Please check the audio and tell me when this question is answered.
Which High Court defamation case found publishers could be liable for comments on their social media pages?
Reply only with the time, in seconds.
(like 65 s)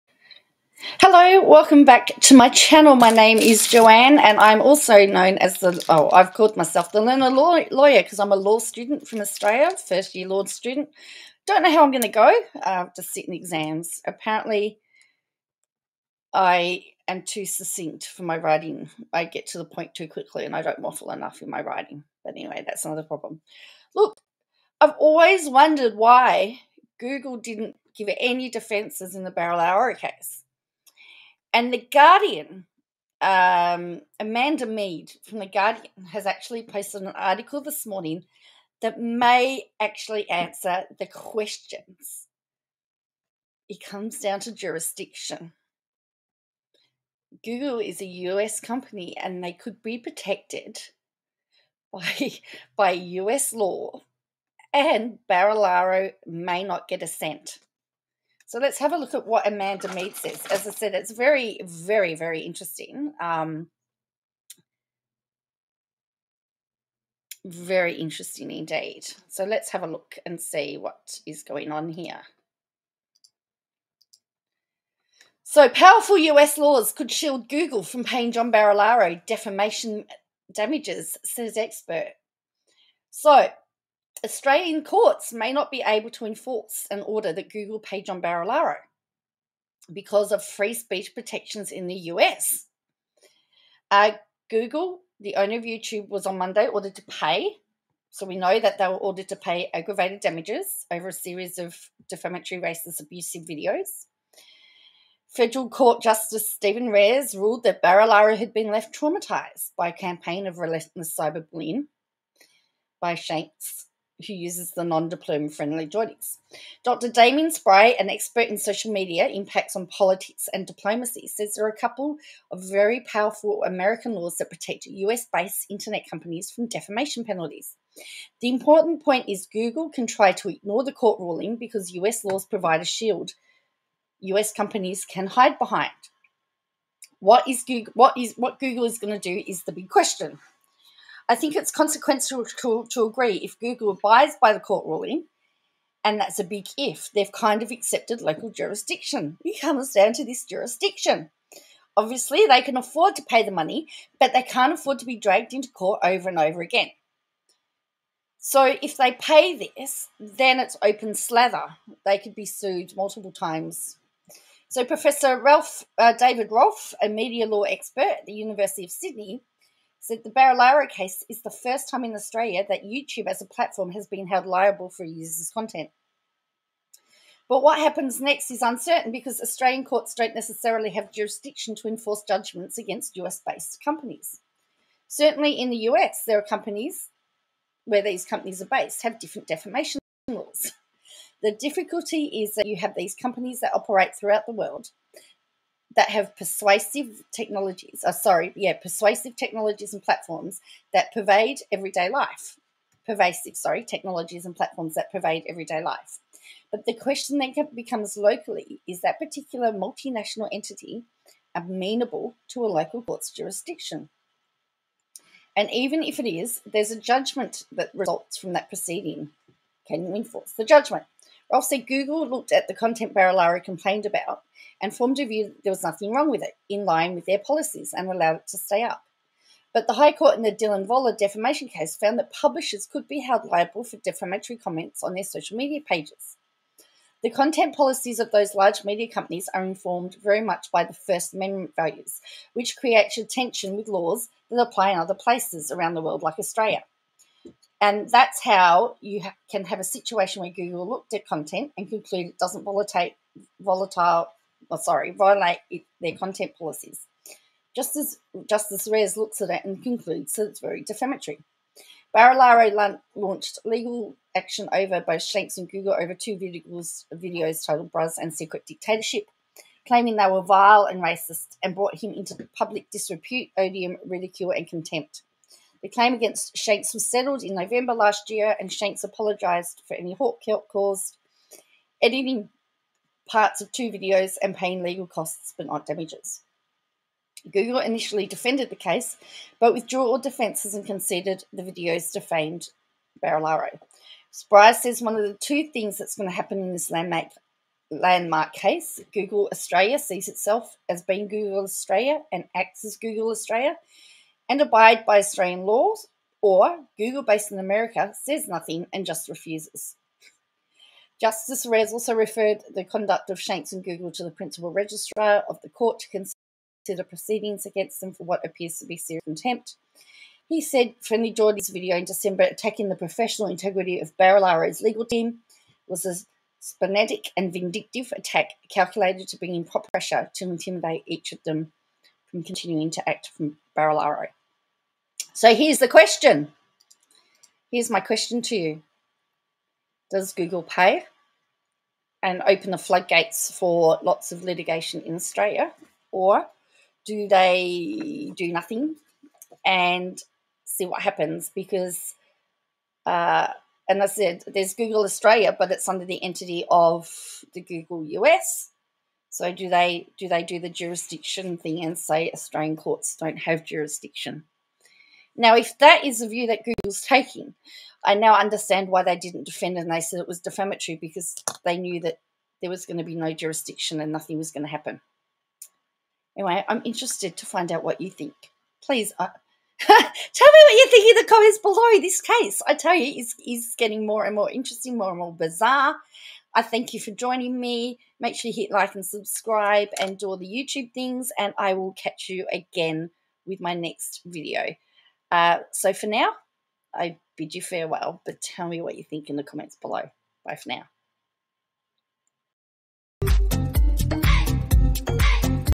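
230 s.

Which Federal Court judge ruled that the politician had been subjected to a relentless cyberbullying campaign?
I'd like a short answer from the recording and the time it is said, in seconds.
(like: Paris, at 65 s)
Stephen Rares, at 106 s.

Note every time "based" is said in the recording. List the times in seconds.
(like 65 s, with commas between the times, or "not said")
124 s, 183 s, 188 s, 307 s.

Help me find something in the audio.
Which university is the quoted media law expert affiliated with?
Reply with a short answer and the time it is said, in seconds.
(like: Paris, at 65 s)
University of Sydney, at 168 s.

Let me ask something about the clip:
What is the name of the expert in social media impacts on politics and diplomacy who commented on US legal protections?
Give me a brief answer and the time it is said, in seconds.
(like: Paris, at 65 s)
Damien Spry, at 117 s.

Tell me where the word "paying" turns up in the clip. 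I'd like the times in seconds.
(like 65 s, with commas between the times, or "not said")
78 s, 284 s.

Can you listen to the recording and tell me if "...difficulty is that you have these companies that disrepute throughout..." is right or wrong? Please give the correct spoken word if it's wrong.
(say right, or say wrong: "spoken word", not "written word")
wrong: "operate", not "disrepute".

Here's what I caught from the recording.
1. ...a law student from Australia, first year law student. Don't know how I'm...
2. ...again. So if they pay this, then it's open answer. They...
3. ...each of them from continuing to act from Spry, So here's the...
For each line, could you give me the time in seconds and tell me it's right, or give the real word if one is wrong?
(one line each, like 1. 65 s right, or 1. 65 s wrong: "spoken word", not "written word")
1. 8 s right
2. 156 s wrong: "slather", not "answer"
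3. 331 s wrong: "Barilaro", not "Spry".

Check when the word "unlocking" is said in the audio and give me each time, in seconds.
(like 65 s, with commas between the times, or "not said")
not said.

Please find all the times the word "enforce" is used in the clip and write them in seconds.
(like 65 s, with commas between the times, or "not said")
86 s, 181 s, 220 s.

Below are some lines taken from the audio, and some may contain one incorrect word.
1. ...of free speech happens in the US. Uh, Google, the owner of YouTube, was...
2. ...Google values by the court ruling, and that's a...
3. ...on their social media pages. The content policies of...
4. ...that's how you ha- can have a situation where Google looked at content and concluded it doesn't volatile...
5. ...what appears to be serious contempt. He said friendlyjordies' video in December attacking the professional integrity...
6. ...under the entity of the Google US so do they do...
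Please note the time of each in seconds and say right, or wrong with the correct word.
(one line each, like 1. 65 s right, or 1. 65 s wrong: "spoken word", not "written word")
1. 90 s wrong: "protections", not "happens"
2. 143 s wrong: "abides", not "values"
3. 235 s right
4. 248 s right
5. 318 s right
6. 355 s right.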